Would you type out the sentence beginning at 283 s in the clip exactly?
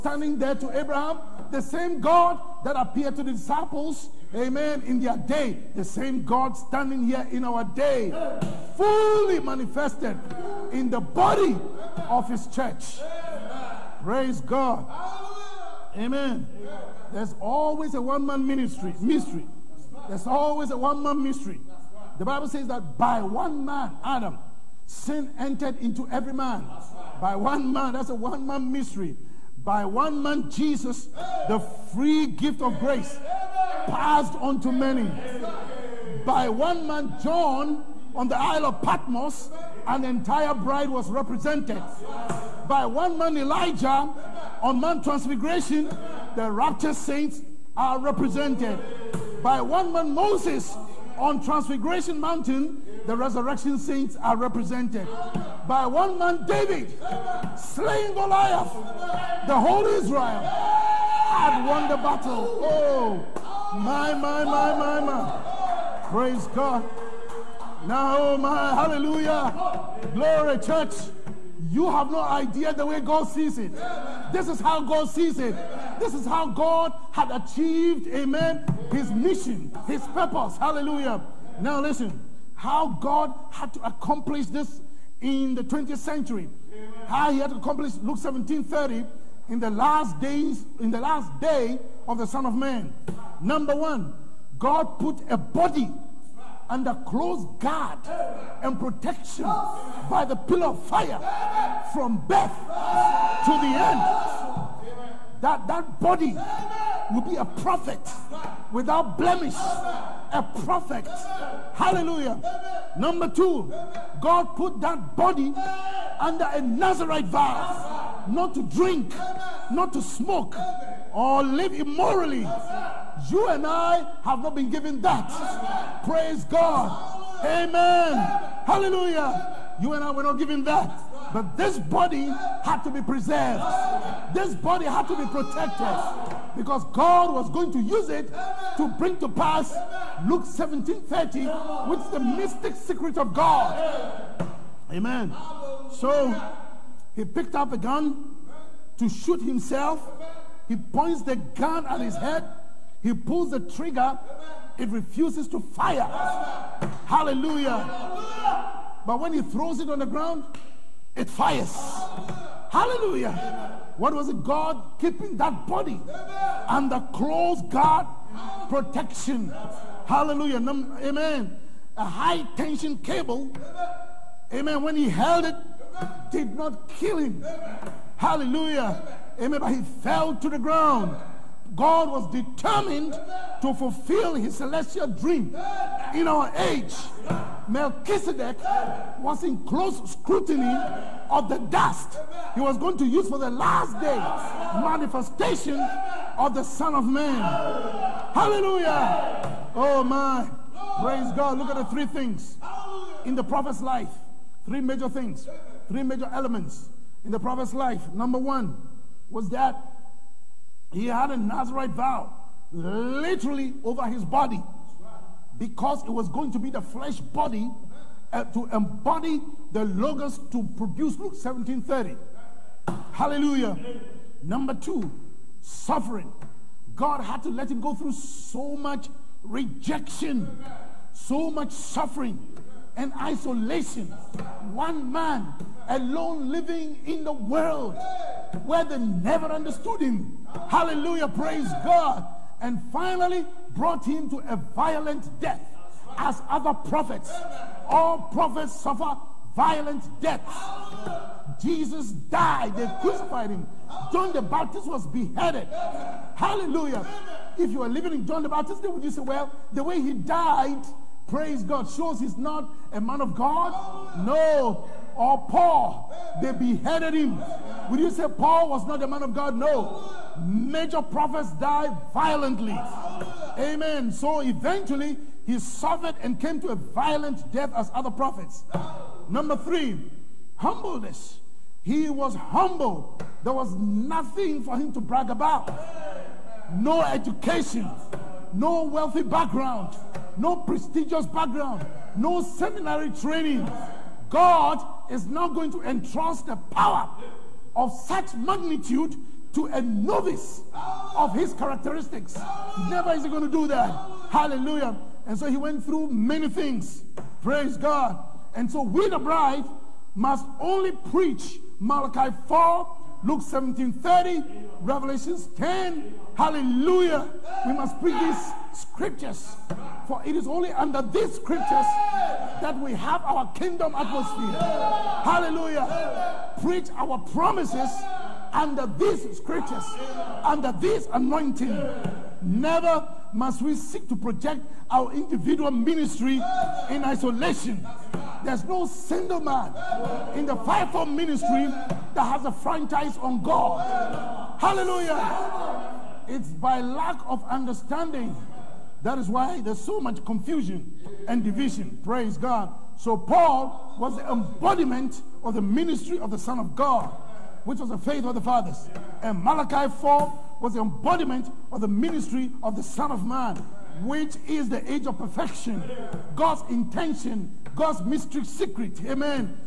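There was nothing for him to brag about.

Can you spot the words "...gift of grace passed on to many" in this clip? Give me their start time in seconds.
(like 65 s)
32 s.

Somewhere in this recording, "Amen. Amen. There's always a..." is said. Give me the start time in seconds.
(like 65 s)
15 s.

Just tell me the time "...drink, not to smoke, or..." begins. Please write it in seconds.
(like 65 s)
118 s.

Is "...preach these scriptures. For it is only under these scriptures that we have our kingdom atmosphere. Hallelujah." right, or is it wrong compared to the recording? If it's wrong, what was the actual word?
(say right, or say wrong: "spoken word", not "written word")
right.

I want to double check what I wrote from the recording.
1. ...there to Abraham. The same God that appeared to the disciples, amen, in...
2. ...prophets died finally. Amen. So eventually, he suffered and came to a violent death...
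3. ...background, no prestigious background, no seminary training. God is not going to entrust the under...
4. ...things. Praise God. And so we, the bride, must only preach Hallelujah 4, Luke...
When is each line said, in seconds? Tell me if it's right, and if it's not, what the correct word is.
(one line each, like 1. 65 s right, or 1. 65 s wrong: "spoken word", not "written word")
1. 0 s right
2. 271 s wrong: "violently", not "finally"
3. 289 s wrong: "power", not "under"
4. 306 s wrong: "Malachi", not "Hallelujah".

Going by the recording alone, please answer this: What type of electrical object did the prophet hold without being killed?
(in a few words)
high tension cable.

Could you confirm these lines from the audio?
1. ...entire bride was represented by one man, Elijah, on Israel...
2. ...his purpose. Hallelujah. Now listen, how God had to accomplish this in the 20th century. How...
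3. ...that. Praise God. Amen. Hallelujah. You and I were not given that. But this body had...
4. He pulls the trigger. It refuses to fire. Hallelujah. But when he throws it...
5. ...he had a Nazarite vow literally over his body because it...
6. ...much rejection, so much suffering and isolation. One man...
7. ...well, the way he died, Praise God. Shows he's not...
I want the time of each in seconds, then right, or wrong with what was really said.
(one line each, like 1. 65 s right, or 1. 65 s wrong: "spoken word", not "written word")
1. 40 s wrong: "Mount", not "Israel"
2. 79 s right
3. 125 s right
4. 153 s right
5. 210 s right
6. 228 s right
7. 259 s right.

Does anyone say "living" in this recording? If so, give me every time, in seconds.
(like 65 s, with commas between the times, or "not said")
236 s, 257 s.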